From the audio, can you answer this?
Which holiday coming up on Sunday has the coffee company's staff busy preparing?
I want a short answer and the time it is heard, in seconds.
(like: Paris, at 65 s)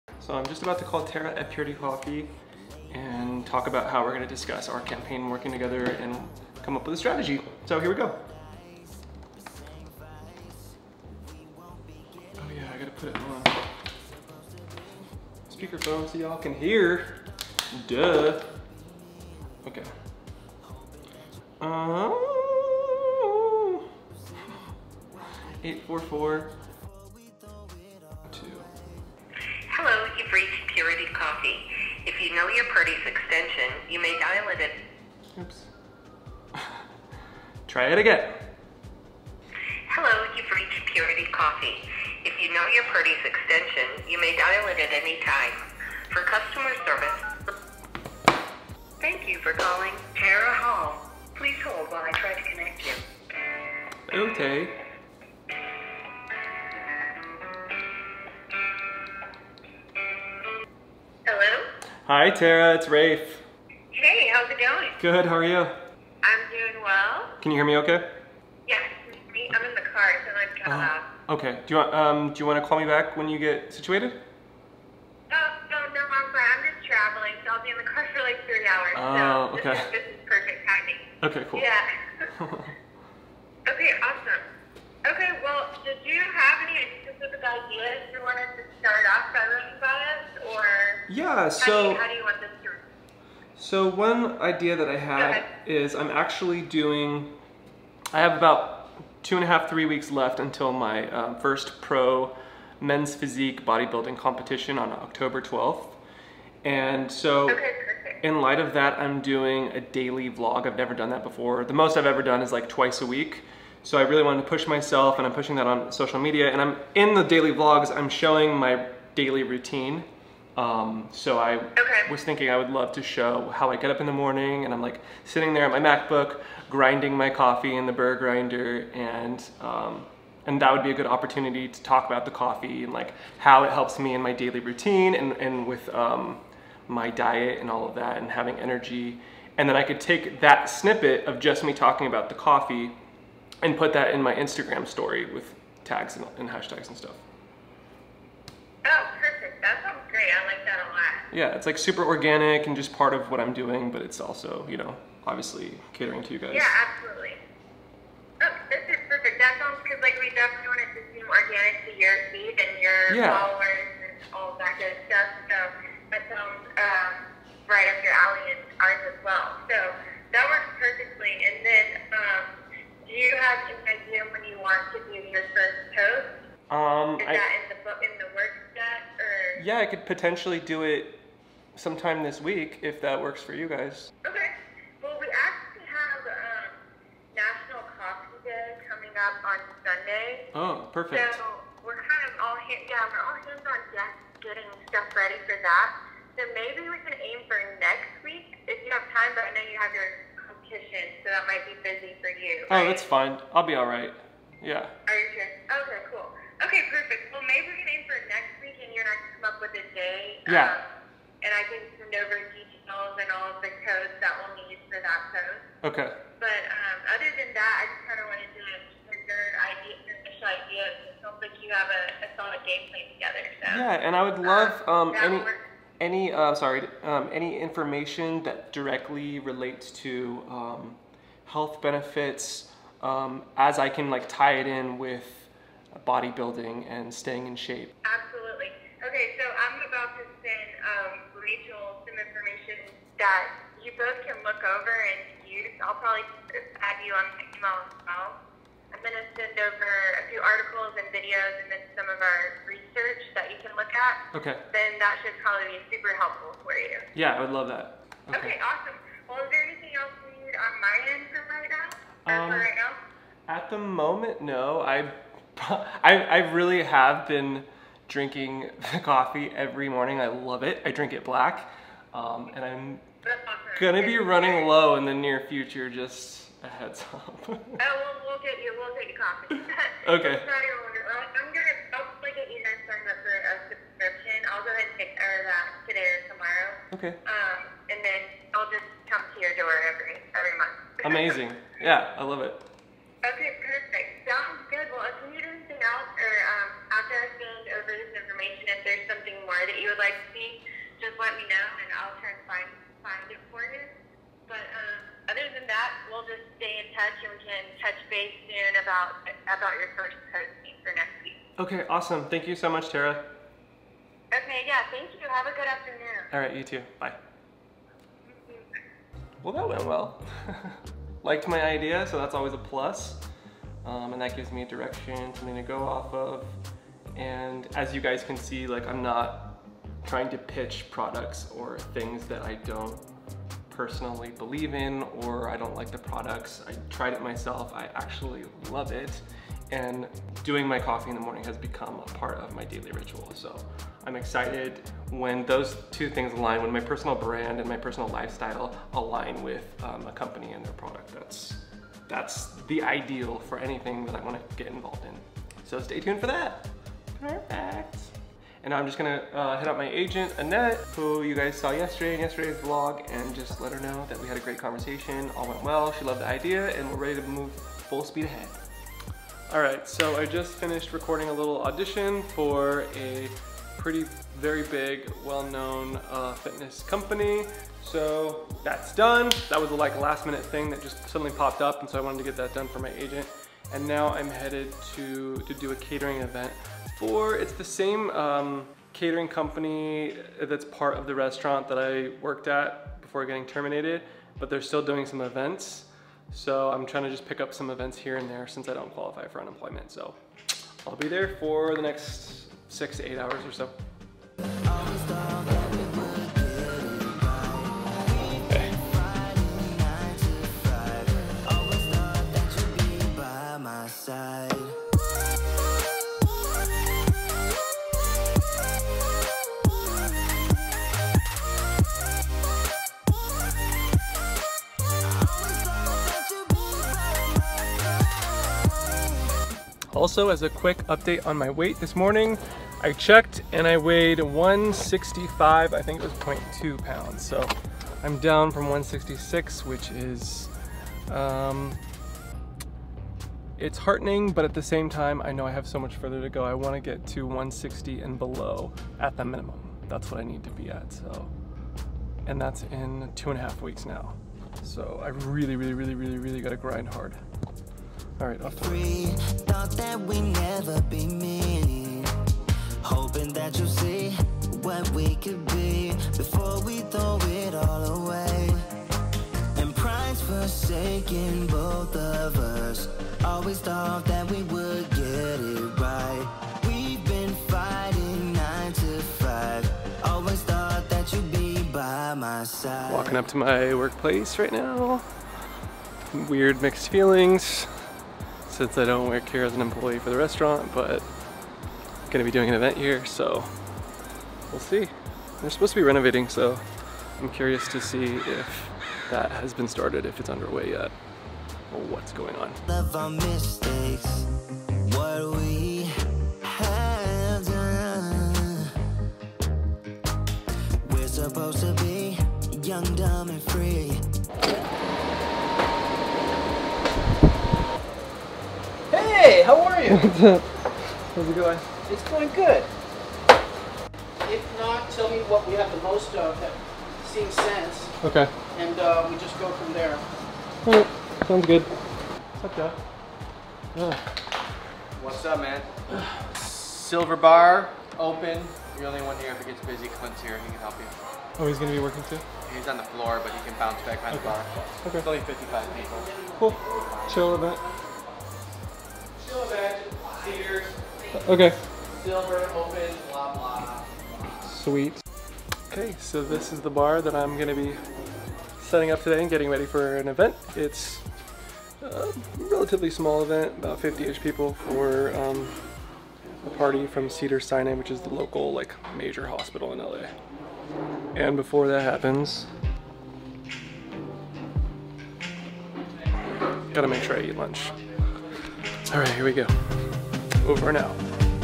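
National Coffee Day, at 187 s.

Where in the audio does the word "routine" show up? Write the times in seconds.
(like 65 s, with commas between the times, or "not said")
119 s, 134 s.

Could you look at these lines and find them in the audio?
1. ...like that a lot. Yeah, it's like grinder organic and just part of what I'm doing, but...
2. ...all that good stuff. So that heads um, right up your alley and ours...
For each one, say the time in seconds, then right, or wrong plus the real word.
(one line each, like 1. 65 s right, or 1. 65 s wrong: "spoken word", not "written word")
1. 150 s wrong: "super", not "grinder"
2. 164 s wrong: "sounds", not "heads".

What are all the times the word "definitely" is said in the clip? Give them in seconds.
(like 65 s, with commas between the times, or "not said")
160 s.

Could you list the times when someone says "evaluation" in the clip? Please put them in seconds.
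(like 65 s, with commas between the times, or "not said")
not said.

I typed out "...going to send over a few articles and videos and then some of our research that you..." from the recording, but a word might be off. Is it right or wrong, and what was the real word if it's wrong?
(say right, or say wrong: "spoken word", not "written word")
right.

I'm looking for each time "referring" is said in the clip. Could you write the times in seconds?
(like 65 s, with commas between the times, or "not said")
not said.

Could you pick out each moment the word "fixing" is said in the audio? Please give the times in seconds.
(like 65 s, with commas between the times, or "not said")
not said.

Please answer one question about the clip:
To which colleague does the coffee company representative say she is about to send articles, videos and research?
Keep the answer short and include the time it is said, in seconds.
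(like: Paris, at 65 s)
Rachel, at 241 s.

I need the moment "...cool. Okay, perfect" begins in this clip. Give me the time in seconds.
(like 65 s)
206 s.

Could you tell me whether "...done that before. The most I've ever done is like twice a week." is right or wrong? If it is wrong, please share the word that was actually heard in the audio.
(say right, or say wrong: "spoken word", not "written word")
right.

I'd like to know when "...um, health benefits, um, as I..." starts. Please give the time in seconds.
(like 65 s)
230 s.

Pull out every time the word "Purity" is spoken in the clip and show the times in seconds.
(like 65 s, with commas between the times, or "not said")
1 s, 40 s.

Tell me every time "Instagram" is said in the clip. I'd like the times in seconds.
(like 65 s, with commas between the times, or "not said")
144 s.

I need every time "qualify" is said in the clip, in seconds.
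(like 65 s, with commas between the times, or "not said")
398 s.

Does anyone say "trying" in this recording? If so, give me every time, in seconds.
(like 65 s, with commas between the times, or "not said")
330 s, 396 s.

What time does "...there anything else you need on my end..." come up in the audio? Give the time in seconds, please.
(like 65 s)
259 s.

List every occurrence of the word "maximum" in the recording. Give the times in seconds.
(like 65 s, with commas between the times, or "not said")
not said.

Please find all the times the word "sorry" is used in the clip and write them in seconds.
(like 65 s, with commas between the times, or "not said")
226 s, 280 s.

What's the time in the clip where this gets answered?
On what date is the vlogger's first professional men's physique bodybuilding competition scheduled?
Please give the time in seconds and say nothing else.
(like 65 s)
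104 s.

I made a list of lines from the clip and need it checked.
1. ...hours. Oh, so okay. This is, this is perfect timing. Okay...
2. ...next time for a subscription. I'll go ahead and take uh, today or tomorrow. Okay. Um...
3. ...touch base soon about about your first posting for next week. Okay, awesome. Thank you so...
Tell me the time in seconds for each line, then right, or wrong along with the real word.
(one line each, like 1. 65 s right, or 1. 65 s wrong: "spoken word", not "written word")
1. 78 s right
2. 282 s right
3. 307 s right.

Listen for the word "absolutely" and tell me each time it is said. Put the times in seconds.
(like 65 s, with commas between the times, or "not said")
156 s, 238 s.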